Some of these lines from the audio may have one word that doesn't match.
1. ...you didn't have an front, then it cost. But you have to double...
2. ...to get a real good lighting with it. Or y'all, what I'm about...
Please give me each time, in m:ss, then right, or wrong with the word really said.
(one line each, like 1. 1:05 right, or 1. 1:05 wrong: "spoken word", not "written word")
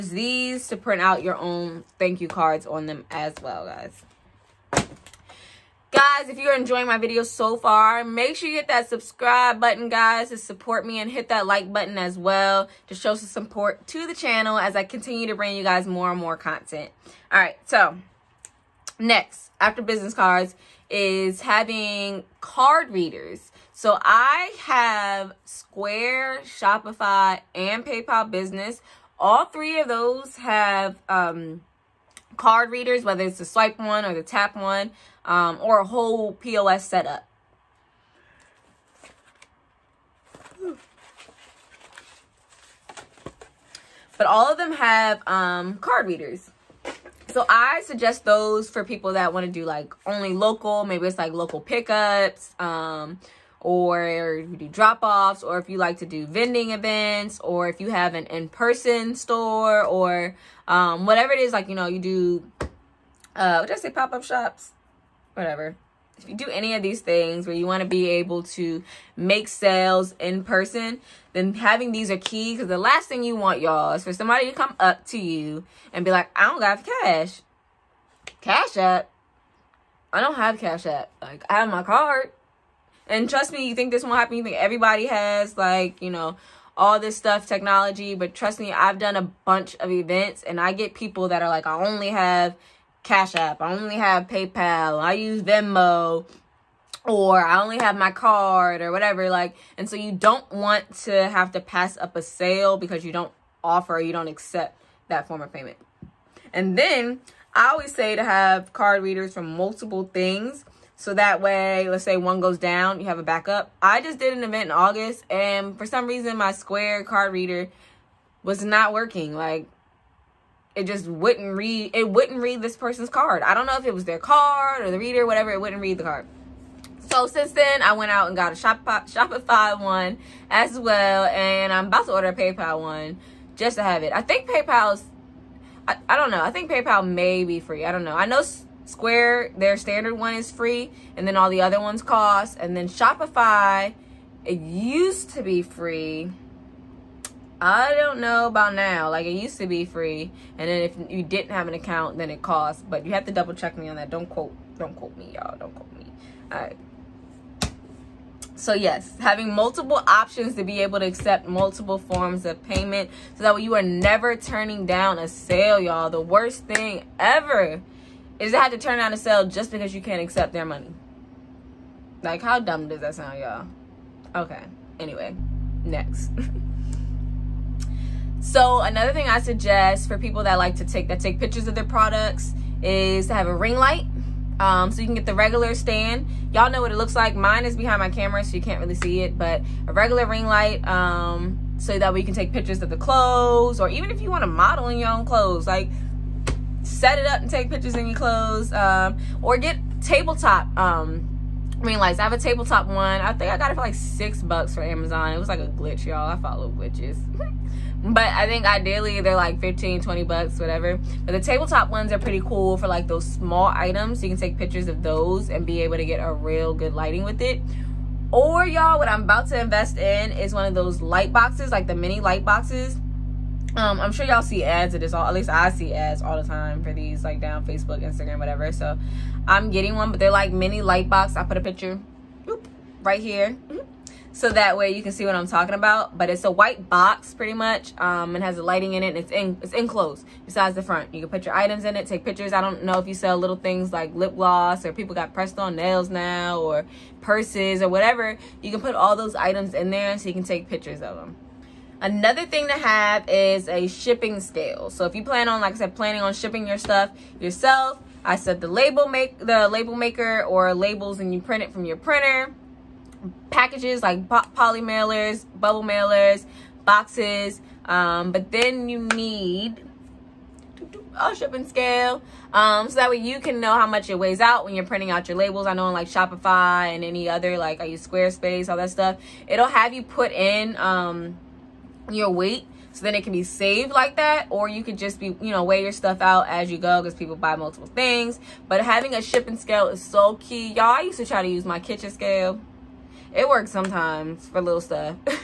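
1. 2:31 wrong: "account", not "front"
2. 3:35 right.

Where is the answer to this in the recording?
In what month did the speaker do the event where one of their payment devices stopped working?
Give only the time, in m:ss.
1:54.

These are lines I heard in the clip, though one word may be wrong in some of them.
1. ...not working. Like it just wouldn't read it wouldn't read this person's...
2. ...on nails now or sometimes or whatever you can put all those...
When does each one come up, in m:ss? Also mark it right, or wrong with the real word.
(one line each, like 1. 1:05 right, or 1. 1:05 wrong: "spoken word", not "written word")
1. 1:58 right
2. 4:05 wrong: "purses", not "sometimes".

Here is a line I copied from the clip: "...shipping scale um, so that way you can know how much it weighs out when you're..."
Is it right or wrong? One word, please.
right.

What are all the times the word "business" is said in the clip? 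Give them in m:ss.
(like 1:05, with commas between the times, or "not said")
0:19, 0:28.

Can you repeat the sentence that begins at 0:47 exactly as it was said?
So I suggest those for people that want to do like only local.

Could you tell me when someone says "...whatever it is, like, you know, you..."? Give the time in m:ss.
1:01.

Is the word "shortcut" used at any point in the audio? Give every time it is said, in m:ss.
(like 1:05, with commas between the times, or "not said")
not said.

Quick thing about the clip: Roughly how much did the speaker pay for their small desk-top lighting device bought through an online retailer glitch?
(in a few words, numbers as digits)
$6.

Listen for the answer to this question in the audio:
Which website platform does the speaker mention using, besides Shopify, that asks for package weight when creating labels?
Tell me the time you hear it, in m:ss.
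4:38.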